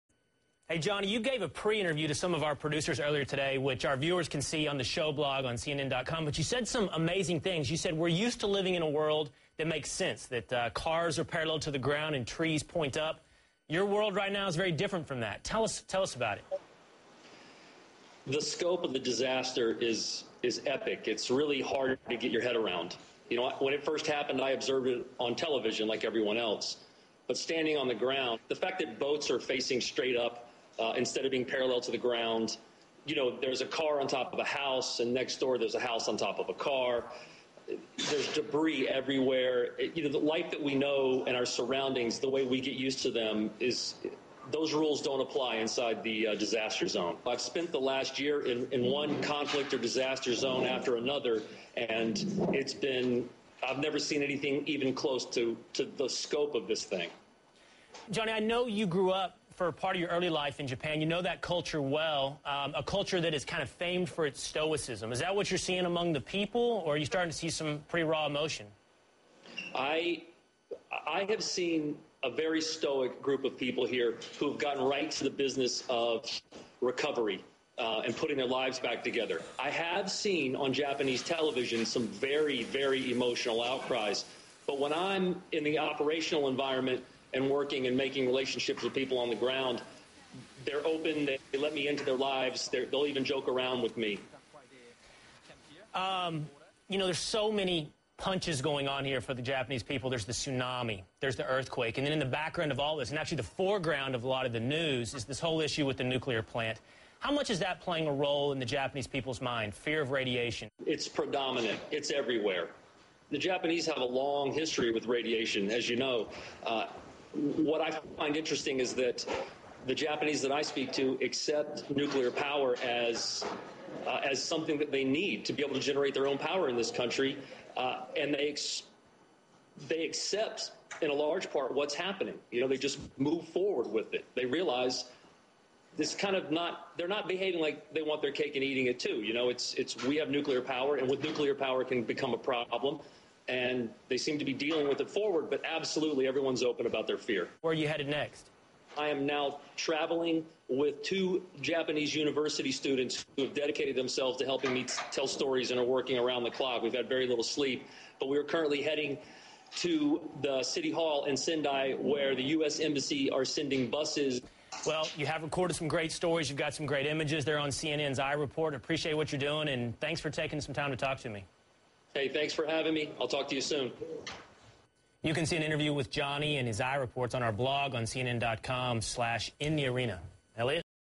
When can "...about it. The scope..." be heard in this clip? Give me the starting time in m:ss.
0:16.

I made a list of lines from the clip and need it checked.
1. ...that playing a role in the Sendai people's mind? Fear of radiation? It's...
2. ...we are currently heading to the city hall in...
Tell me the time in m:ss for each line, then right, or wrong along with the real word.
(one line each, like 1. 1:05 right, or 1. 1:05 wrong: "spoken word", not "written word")
1. 1:47 wrong: "Japanese", not "Sendai"
2. 2:38 right.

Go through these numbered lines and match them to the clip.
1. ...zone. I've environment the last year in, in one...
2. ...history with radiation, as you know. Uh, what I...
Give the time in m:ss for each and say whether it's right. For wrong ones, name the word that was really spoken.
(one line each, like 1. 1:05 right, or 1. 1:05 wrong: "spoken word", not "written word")
1. 0:46 wrong: "spent", not "environment"
2. 1:54 right.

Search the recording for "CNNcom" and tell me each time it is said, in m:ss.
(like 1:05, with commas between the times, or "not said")
0:05, 2:58.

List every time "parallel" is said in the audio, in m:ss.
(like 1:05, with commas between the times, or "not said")
0:11, 0:31.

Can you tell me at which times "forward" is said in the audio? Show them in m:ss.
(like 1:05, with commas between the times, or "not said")
2:13, 2:25.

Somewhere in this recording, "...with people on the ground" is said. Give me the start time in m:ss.
1:28.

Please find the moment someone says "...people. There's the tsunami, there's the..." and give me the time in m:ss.
1:39.